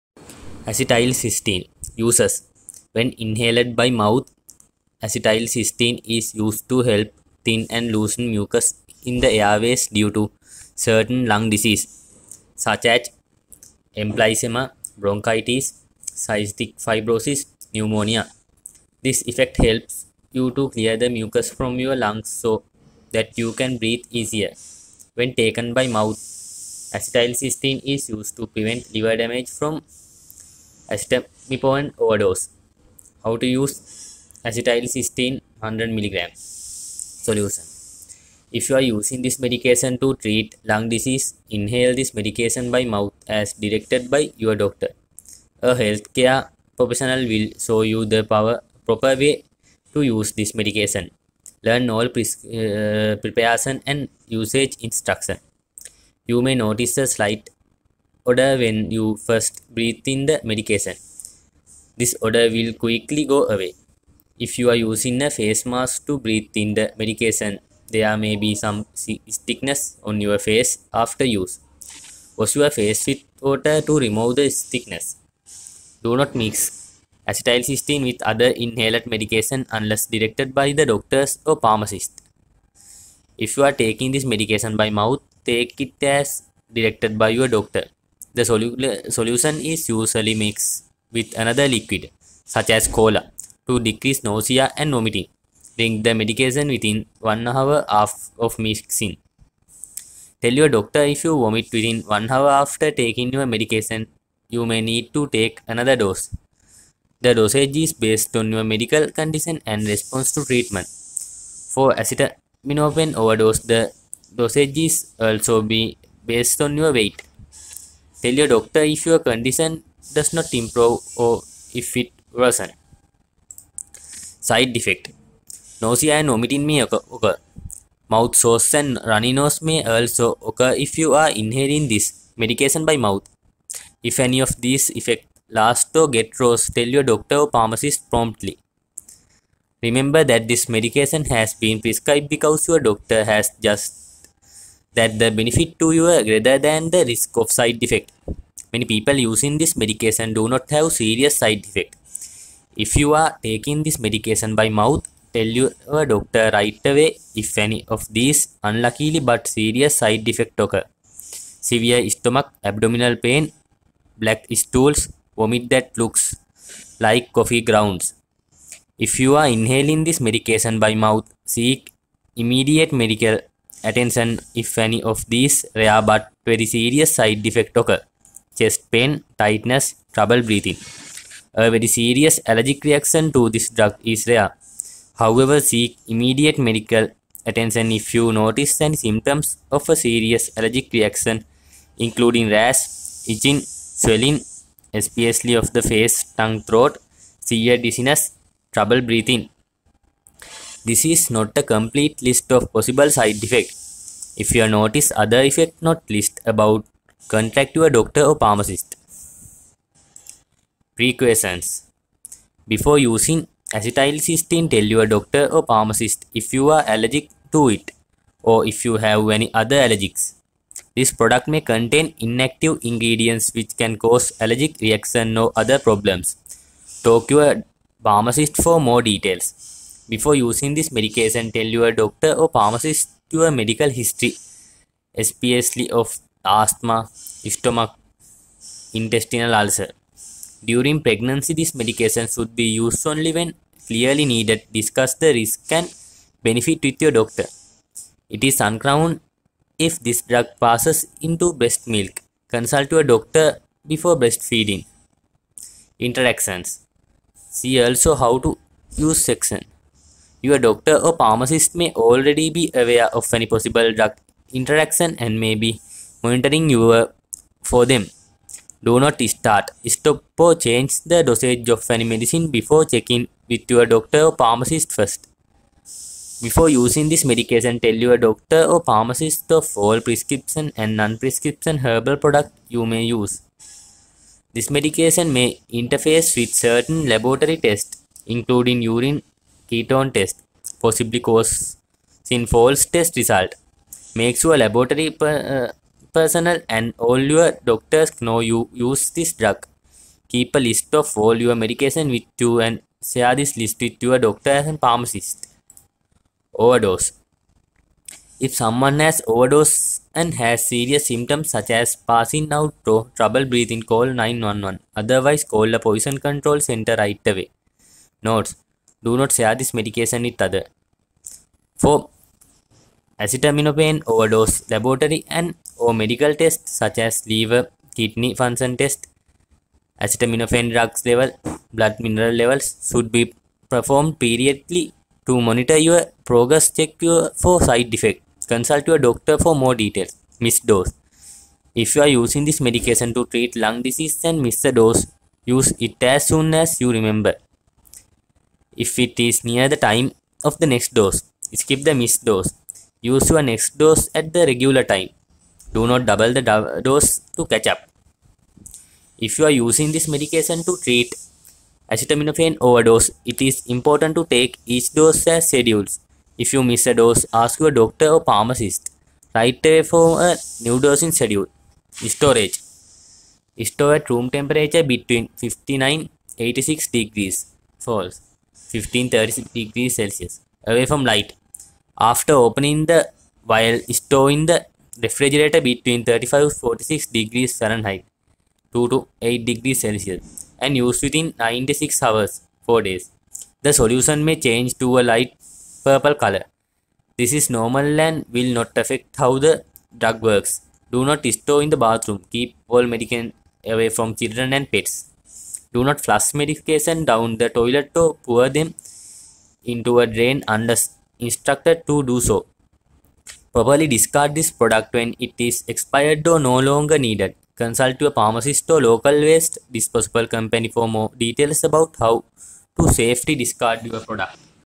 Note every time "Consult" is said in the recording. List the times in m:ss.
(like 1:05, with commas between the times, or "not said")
4:12, 5:38, 6:57.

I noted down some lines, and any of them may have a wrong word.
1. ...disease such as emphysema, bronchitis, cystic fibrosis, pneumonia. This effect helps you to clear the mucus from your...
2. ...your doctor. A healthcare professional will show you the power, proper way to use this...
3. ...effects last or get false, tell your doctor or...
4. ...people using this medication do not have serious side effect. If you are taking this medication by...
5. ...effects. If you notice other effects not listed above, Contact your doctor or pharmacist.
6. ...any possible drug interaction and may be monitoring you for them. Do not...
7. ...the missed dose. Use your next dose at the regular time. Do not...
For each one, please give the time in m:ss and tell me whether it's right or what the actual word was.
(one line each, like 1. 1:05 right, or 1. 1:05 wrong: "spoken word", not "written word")
1. 0:11 right
2. 0:44 right
3. 2:14 wrong: "worse", not "false"
4. 2:28 right
5. 3:23 right
6. 4:23 right
7. 5:51 right.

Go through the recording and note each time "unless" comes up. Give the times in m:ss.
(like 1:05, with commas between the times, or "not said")
1:19, 6:50.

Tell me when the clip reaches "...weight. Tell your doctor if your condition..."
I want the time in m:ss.
1:56.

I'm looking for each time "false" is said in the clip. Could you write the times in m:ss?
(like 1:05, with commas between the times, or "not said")
4:52, 6:17.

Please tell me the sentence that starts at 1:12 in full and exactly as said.
Wash your face with water to remove the stickiness.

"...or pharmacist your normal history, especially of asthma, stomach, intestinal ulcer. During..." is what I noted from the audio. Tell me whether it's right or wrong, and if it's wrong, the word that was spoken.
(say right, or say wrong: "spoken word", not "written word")
wrong: "medical", not "normal".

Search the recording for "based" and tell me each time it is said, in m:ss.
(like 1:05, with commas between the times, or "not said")
1:47, 1:56.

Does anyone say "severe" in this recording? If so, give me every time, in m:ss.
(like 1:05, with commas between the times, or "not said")
2:41, 3:17.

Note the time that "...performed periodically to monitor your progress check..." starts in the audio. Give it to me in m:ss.
5:33.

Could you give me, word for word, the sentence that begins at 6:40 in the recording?
Do not store in the bathroom.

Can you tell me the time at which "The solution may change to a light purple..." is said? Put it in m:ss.
6:33.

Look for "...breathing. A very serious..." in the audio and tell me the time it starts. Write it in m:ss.
3:00.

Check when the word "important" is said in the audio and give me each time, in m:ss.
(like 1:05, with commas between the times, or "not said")
6:03.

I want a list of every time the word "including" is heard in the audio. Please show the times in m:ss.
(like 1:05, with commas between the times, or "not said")
3:11, 4:48.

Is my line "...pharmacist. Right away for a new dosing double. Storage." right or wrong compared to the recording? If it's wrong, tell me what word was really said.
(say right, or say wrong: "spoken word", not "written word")
wrong: "schedule", not "double".